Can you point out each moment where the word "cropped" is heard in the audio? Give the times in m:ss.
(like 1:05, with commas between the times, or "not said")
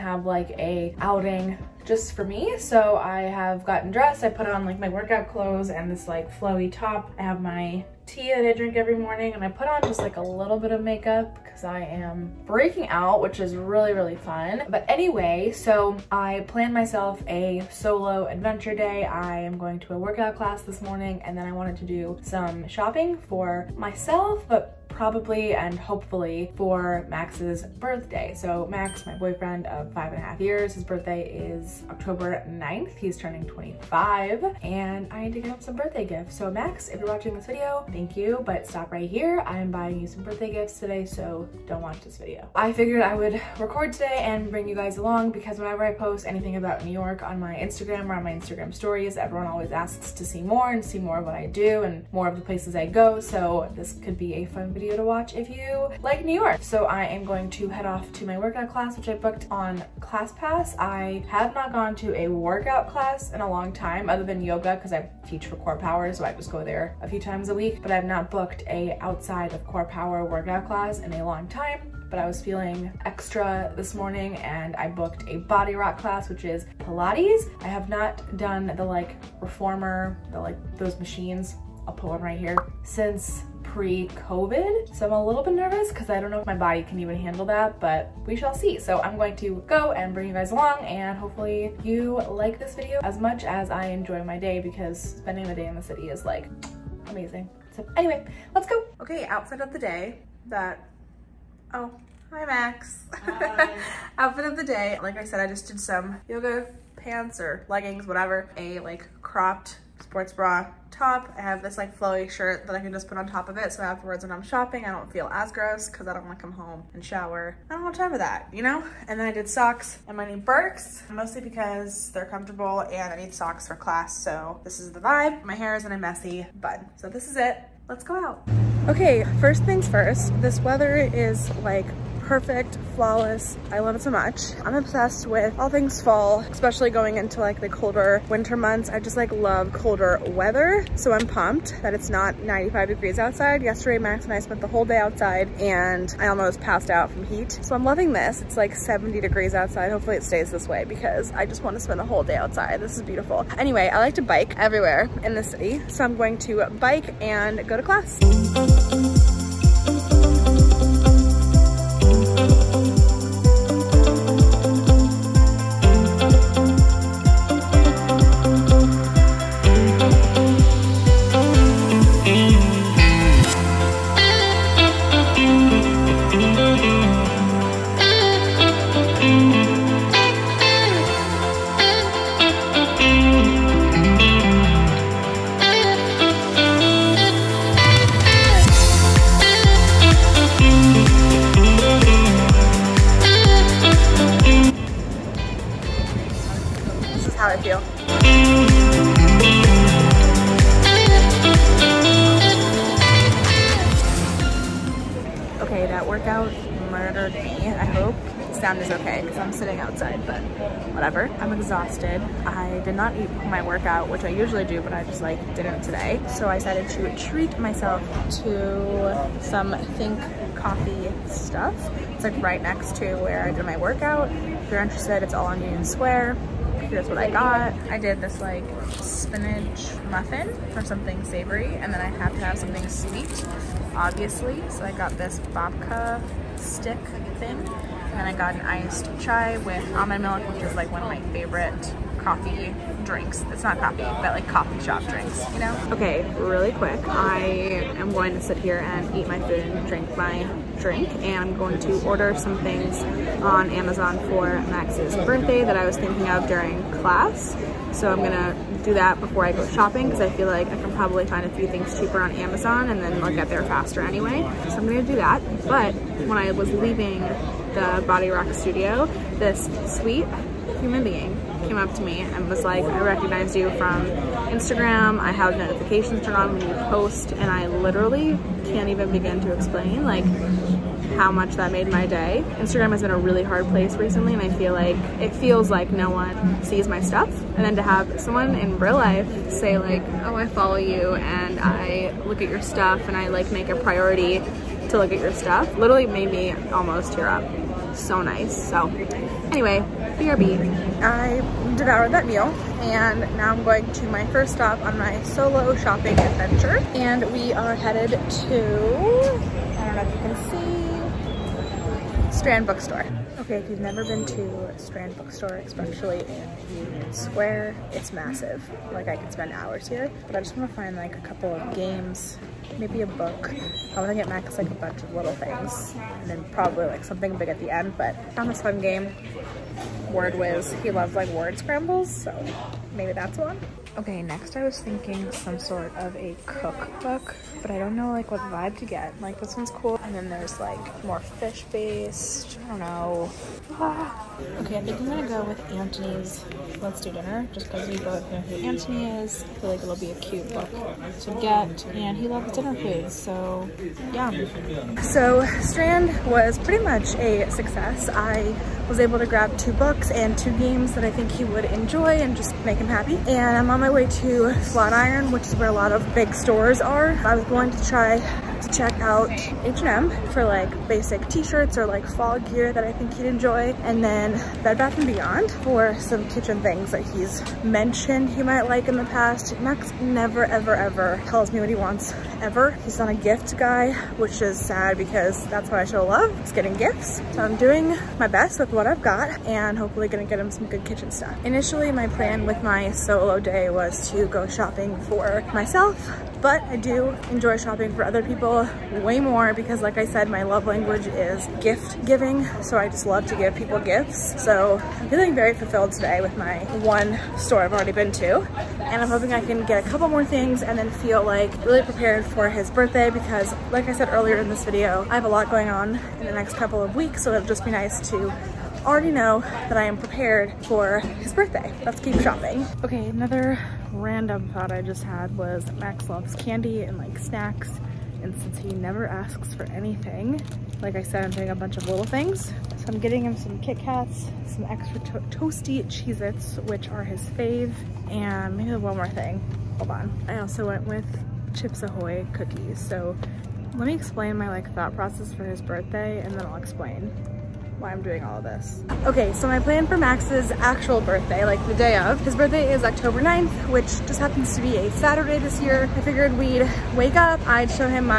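1:49.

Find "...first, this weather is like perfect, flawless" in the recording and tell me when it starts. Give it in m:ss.
2:09.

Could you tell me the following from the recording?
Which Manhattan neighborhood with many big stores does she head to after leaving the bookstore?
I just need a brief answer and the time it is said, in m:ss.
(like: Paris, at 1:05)
Flatiron, at 6:04.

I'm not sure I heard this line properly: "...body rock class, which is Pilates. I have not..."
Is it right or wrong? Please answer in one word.
right.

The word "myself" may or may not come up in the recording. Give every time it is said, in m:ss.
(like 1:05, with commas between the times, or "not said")
0:16, 0:23, 3:37, 6:35.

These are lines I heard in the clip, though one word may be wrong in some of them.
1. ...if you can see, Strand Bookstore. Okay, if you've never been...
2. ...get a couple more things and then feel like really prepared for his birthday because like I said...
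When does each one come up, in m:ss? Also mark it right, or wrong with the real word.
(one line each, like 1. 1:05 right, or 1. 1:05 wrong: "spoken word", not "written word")
1. 5:10 right
2. 6:49 right.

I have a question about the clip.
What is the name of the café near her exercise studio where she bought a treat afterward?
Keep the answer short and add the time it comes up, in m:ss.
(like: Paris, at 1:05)
Think Coffee, at 3:39.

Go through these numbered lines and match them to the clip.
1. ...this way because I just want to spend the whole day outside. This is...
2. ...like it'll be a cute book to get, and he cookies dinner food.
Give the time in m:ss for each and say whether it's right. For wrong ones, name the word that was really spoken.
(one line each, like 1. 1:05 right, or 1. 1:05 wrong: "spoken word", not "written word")
1. 2:30 right
2. 5:49 wrong: "loves", not "cookies".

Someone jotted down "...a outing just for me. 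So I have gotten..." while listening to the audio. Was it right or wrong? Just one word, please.
right.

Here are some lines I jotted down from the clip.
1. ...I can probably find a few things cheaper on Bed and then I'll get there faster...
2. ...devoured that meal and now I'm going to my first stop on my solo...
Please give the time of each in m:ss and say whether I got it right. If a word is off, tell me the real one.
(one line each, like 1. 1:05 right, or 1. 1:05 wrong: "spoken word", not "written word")
1. 4:20 wrong: "Amazon", not "Bed"
2. 5:01 right.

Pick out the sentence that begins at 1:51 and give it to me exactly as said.
I have this like flowy shirt that I can just put on top of it.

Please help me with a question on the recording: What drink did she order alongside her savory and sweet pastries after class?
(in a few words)
iced chai with almond milk.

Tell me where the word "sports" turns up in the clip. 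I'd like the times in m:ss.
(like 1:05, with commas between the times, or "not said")
1:50.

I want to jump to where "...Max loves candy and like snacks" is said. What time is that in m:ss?
7:05.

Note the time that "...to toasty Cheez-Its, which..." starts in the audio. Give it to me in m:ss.
7:14.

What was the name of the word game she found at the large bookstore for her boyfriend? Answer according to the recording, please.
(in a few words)
Word Whiz.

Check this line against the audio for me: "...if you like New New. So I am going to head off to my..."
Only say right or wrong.
wrong.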